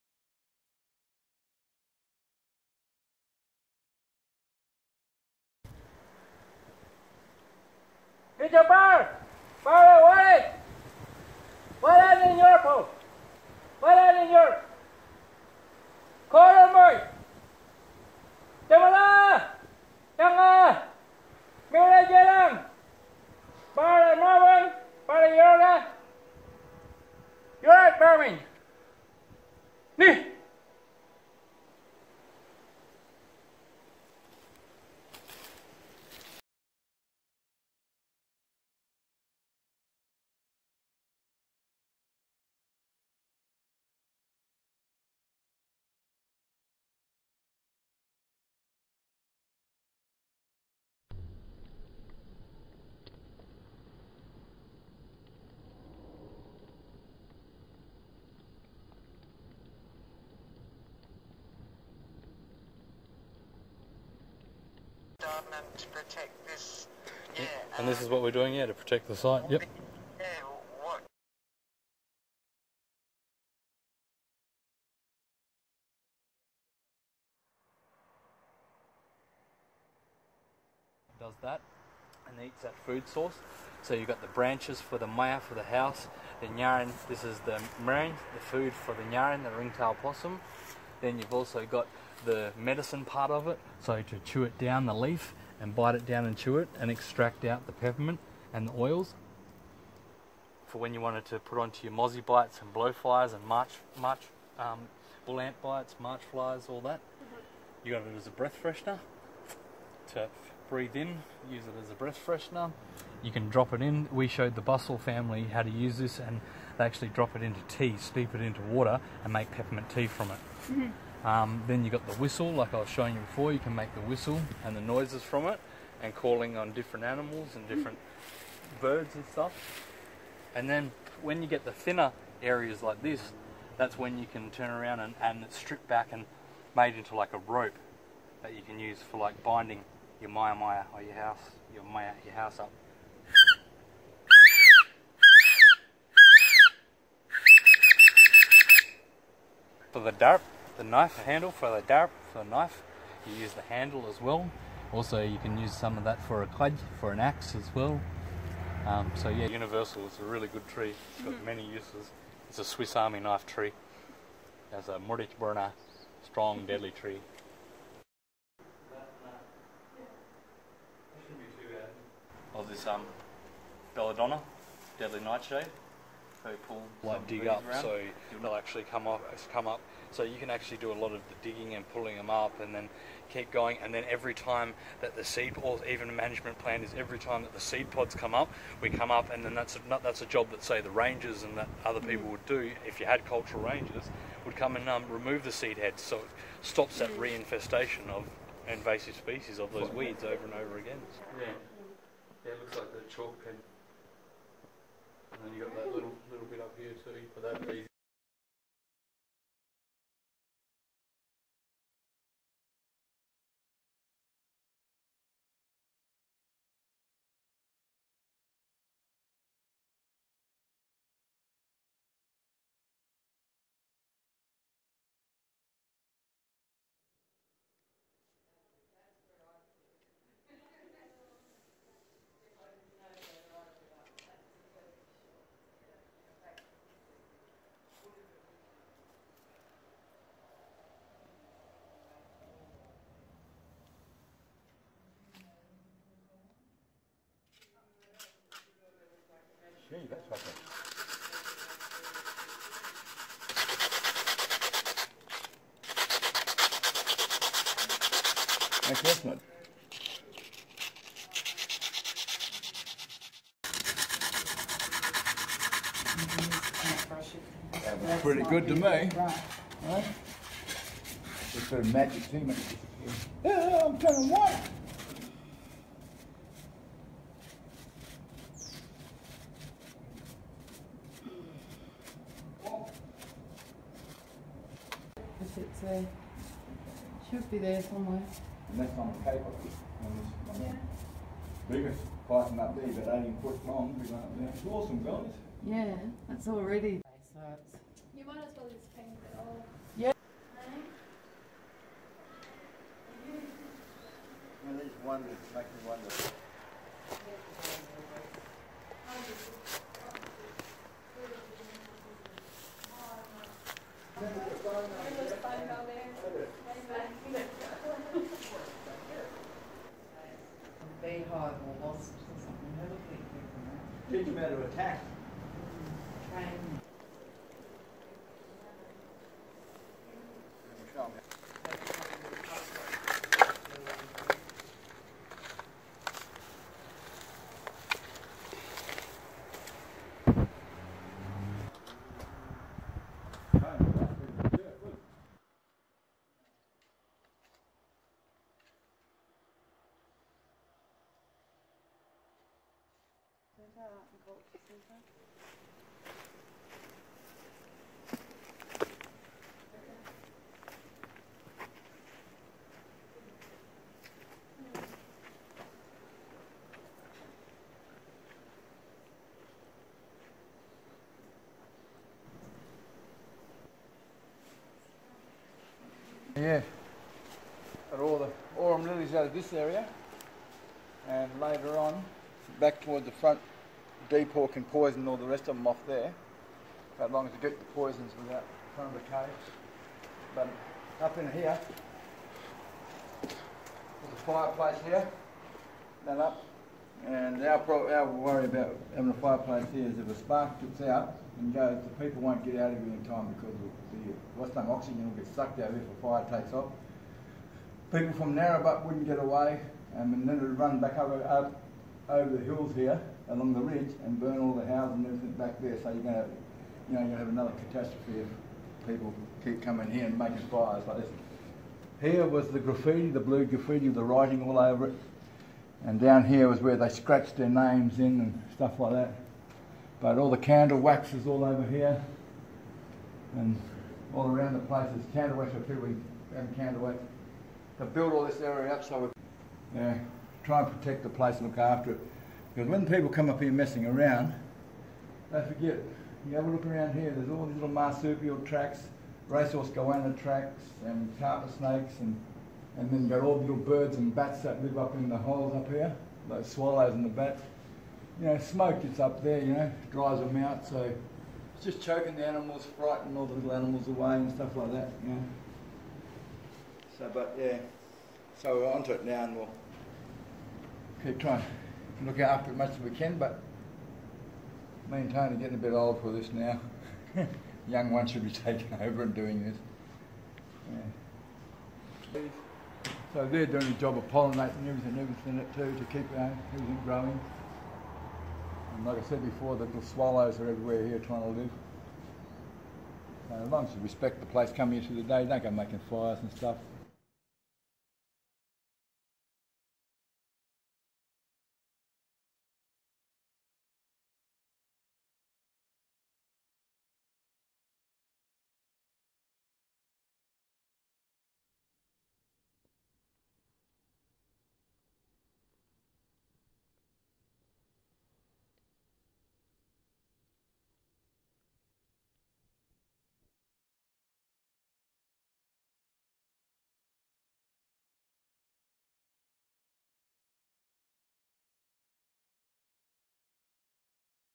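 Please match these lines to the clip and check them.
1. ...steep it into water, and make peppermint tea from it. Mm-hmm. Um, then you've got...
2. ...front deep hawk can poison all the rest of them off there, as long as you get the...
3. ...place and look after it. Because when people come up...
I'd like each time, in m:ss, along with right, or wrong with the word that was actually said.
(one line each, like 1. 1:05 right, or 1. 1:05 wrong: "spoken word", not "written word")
1. 1:57 right
2. 6:23 right
3. 7:21 right.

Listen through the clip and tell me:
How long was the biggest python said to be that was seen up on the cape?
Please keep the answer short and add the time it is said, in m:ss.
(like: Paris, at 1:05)
18 feet, at 4:53.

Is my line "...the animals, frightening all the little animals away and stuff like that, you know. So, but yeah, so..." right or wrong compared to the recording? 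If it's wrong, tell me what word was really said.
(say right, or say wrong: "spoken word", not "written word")
right.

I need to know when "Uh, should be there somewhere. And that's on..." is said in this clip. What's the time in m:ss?
4:46.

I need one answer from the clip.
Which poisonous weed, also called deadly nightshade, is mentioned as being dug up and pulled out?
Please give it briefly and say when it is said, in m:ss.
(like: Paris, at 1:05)
Belladonna, at 2:53.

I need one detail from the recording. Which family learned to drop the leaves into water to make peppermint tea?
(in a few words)
Bustle family.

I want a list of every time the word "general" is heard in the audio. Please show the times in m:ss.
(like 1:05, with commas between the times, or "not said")
not said.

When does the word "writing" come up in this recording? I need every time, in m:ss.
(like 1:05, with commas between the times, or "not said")
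7:04.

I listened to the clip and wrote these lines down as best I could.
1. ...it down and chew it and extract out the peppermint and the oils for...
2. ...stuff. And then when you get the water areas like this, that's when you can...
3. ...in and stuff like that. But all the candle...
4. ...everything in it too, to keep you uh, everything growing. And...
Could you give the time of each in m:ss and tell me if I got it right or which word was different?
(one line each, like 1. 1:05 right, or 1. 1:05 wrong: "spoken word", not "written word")
1. 1:35 right
2. 2:09 wrong: "thinner", not "water"
3. 7:07 right
4. 8:04 right.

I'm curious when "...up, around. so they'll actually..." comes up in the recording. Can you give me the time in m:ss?
2:57.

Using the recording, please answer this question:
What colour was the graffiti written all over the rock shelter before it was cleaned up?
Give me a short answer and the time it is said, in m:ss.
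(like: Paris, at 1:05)
Blue, at 7:03.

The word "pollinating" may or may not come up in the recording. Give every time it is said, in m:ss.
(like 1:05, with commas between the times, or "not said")
8:04.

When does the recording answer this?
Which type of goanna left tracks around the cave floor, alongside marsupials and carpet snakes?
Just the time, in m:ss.
7:29.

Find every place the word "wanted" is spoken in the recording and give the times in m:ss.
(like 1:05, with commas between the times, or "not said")
1:41.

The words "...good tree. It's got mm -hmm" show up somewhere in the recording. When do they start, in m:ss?
2:40.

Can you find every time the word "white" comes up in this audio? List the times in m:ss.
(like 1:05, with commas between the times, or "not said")
4:34.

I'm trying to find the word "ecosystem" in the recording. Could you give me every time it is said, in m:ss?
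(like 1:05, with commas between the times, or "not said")
not said.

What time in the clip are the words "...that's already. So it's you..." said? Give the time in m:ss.
4:56.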